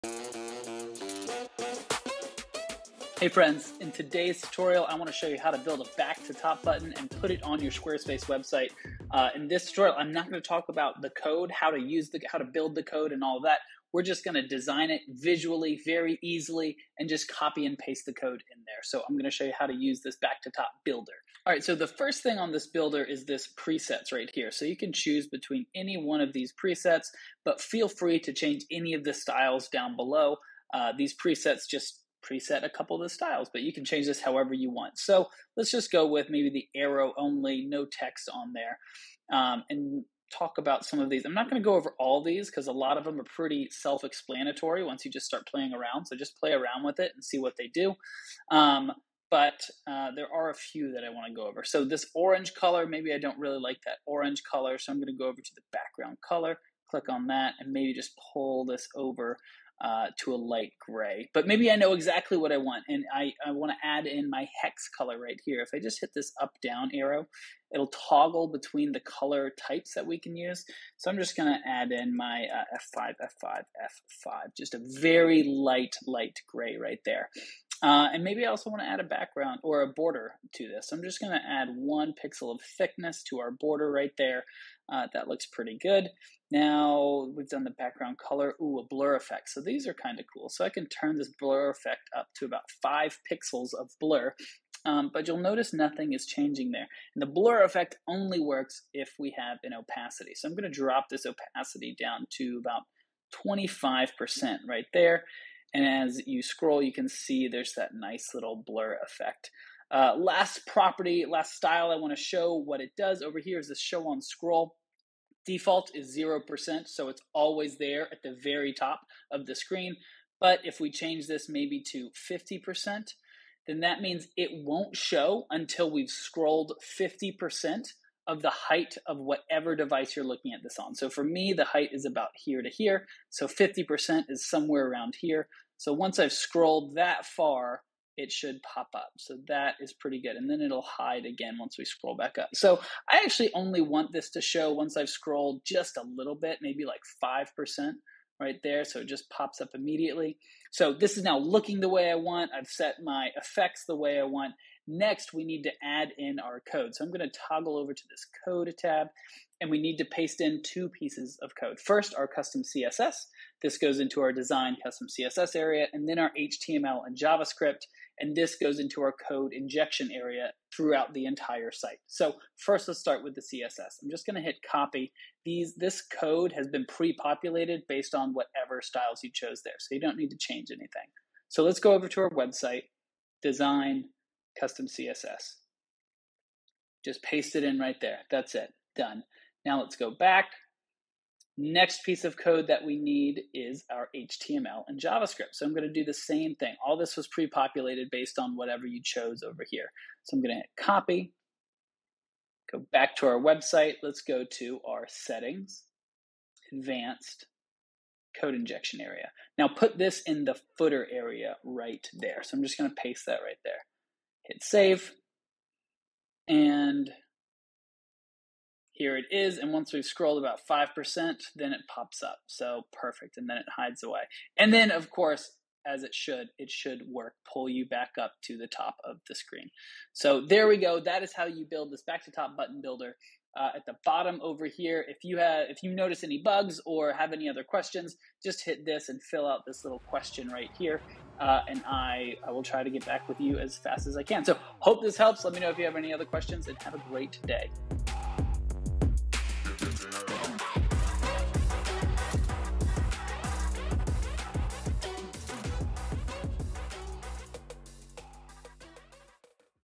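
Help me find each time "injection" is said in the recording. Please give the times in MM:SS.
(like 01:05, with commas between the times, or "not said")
02:49, 03:28.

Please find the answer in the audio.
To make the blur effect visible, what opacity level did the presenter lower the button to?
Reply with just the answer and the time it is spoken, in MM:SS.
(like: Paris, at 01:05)
25%, at 01:43.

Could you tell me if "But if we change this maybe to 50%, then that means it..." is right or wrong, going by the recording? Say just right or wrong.
right.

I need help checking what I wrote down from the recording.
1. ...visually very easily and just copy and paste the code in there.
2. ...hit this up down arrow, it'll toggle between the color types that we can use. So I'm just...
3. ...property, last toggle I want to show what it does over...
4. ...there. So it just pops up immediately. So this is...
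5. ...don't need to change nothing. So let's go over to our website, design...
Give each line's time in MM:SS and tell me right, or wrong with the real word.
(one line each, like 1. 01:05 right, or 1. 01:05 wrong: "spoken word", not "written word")
1. 00:15 right
2. 01:05 right
3. 01:50 wrong: "style", not "toggle"
4. 02:28 right
5. 03:00 wrong: "anything", not "nothing".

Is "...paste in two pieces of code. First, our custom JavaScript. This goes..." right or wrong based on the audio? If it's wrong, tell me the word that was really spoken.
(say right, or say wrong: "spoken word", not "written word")
wrong: "CSS", not "JavaScript".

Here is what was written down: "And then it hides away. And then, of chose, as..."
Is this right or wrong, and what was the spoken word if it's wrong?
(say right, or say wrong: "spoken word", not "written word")
wrong: "course", not "chose".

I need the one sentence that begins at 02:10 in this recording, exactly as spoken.
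So for me, the height is about here to here.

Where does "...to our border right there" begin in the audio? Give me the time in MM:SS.
01:23.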